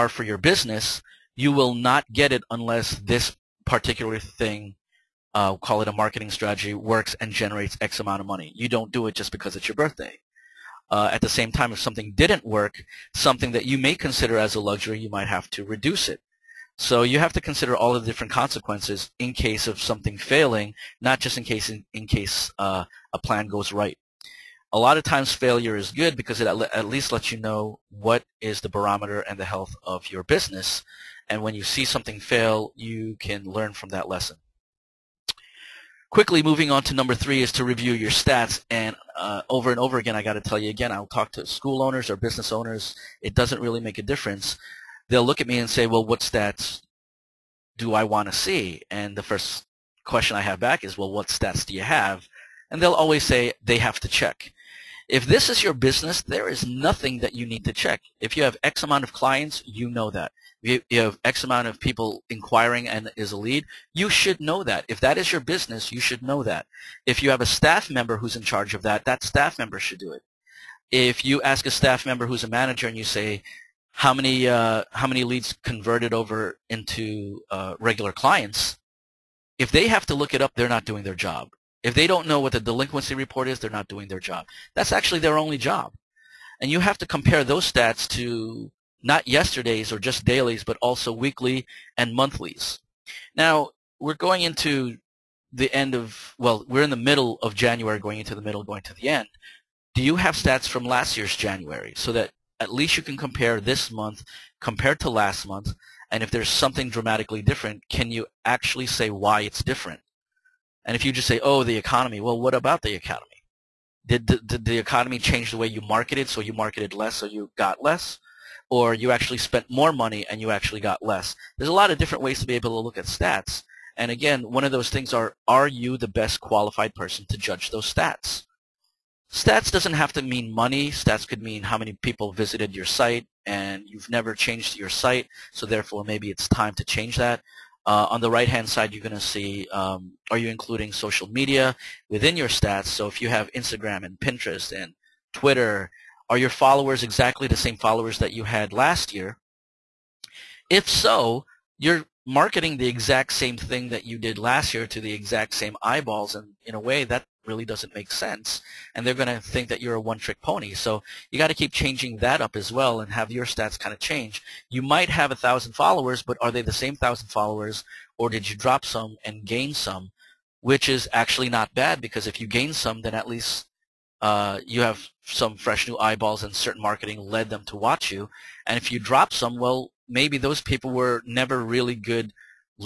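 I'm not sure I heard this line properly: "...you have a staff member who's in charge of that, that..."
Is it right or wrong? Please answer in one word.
right.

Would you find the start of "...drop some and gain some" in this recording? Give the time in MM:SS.
02:48.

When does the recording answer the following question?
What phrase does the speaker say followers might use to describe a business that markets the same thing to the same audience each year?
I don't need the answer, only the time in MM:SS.
02:39.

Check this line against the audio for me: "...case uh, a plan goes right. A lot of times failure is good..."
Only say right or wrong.
right.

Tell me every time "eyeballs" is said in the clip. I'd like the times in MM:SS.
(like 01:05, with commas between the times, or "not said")
02:35, 02:55.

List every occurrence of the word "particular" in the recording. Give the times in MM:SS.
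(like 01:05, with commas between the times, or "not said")
00:03.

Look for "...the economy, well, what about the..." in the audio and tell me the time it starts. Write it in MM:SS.
01:51.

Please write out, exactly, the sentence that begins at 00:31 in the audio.
And when you see something fail, you can learn from that lesson.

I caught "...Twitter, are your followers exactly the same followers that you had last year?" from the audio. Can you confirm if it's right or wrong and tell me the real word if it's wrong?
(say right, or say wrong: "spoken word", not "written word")
right.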